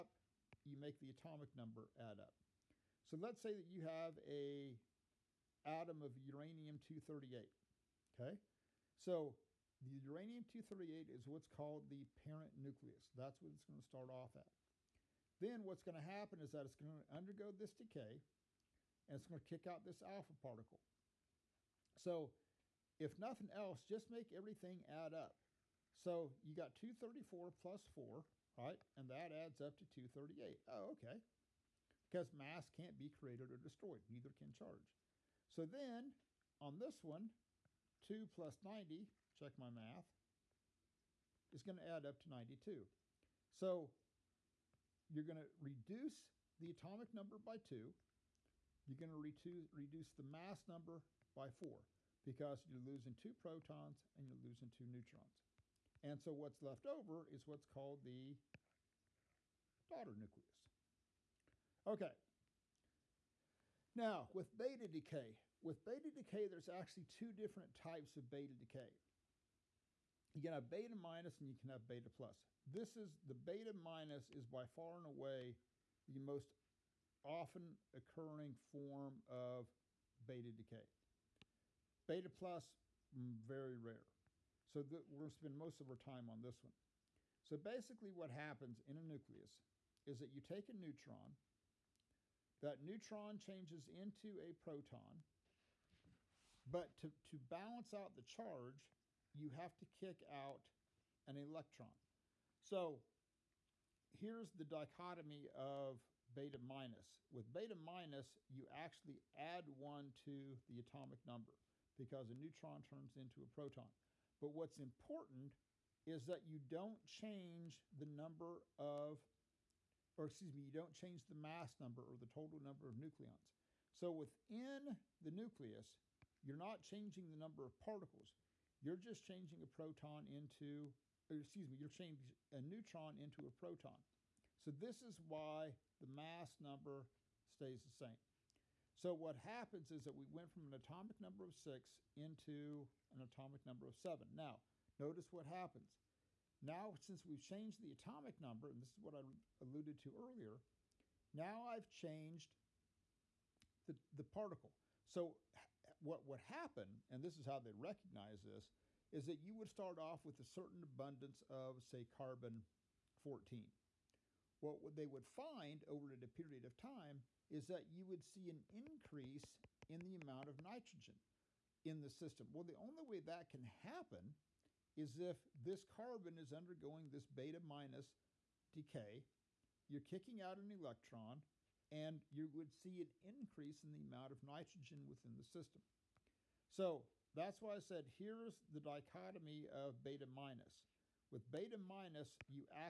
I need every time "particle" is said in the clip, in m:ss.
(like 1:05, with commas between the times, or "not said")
0:20, 2:07, 2:34.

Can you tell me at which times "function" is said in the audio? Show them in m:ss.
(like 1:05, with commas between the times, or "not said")
not said.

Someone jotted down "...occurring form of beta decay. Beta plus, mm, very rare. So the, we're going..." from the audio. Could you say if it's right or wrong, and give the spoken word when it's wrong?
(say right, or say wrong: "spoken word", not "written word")
right.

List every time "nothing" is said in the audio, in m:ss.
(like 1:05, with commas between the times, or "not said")
0:23.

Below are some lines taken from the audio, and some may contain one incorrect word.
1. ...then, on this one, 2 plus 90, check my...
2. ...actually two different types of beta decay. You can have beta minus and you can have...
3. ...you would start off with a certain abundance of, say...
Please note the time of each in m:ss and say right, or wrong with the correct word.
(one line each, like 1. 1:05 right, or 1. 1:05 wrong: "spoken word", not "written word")
1. 0:35 right
2. 1:06 right
3. 2:39 right.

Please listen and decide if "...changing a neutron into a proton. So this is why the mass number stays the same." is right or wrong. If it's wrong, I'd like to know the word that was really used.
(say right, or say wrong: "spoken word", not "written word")
right.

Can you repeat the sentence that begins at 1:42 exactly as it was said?
So here's the dichotomy of beta minus.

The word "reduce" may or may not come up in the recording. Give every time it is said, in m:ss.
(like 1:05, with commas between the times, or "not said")
0:45, 0:49.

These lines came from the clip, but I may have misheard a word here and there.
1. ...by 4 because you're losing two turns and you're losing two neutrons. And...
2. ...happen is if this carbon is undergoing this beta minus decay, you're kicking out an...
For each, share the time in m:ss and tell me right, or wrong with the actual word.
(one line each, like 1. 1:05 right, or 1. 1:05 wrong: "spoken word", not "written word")
1. 0:51 wrong: "protons", not "turns"
2. 2:53 right.